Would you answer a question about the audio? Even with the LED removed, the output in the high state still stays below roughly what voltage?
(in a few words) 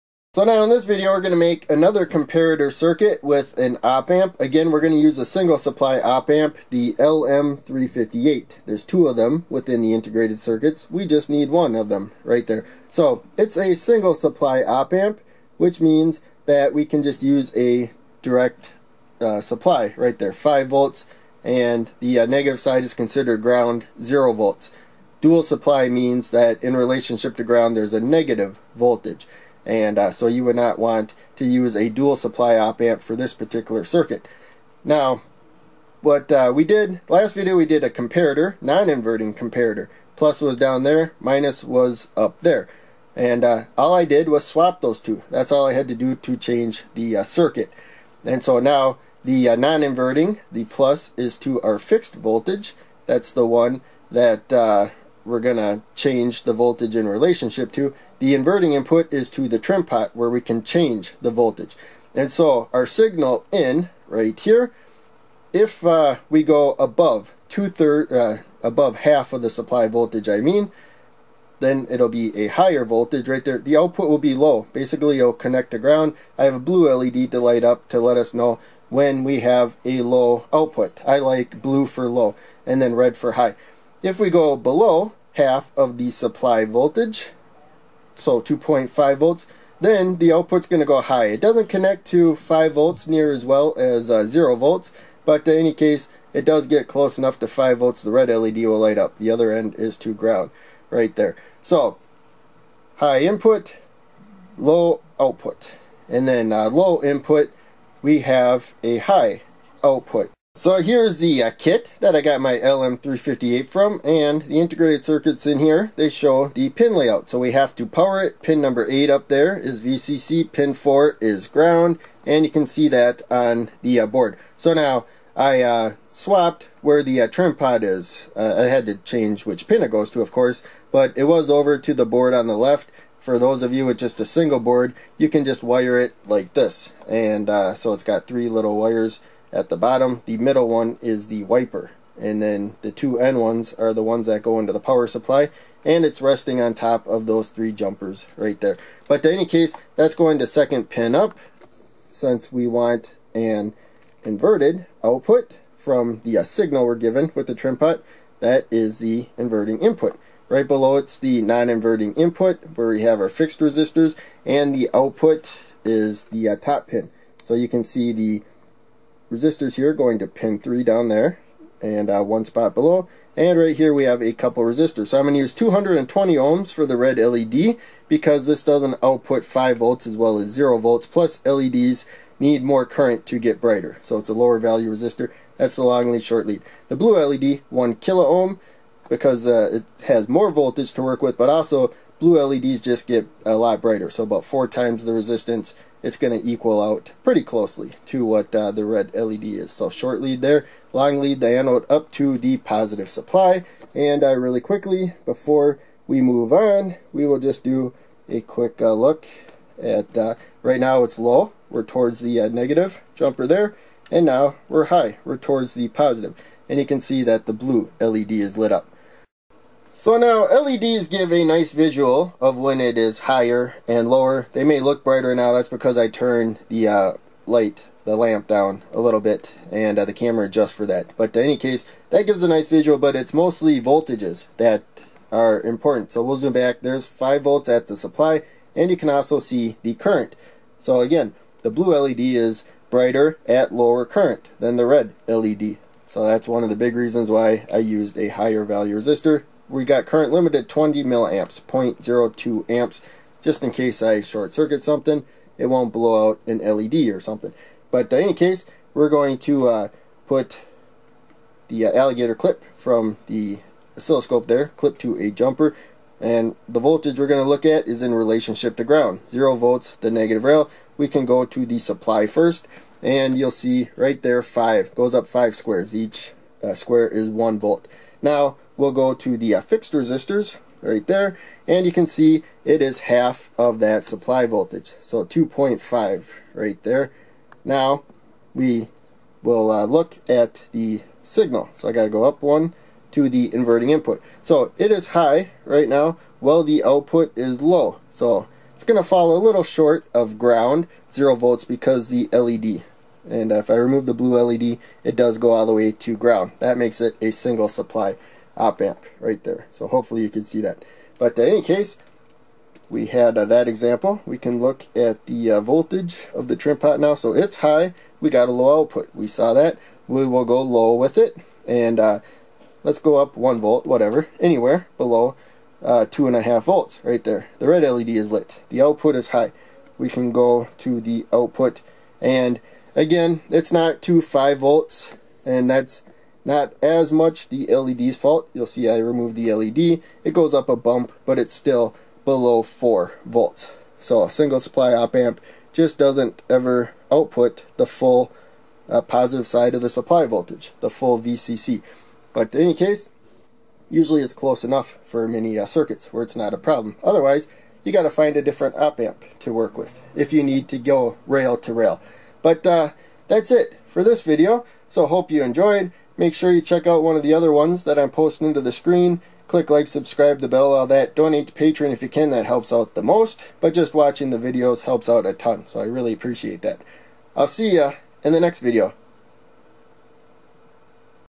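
4 volts.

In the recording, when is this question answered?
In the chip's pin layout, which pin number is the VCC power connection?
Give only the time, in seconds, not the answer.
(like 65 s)
118 s.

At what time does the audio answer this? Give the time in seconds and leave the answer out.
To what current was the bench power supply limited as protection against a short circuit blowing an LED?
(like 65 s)
250 s.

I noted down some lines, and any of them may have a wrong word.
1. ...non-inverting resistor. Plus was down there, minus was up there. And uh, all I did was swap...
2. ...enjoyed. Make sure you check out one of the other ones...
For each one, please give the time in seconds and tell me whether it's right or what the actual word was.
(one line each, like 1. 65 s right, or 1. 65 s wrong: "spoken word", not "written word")
1. 38 s wrong: "comparator", not "resistor"
2. 365 s right.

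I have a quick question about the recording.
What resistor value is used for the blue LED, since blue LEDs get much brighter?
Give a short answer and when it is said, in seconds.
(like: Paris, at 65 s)
1 kilo ohm, at 187 s.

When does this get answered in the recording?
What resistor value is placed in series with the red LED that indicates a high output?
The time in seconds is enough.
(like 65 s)
175 s.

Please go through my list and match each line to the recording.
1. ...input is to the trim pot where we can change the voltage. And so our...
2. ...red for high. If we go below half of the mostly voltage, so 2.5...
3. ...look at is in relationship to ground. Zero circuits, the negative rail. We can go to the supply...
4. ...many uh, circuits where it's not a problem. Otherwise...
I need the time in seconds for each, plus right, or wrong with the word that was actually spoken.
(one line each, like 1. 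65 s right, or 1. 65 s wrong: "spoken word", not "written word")
1. 58 s right
2. 82 s wrong: "supply", not "mostly"
3. 267 s wrong: "volts", not "circuits"
4. 355 s right.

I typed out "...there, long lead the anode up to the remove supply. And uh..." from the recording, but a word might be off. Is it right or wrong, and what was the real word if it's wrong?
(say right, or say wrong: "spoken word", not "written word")
wrong: "positive", not "remove".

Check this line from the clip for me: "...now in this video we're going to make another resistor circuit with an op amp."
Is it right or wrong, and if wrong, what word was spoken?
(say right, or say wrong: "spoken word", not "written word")
wrong: "comparator", not "resistor".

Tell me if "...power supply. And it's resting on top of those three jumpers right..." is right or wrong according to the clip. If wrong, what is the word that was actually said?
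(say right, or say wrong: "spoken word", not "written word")
right.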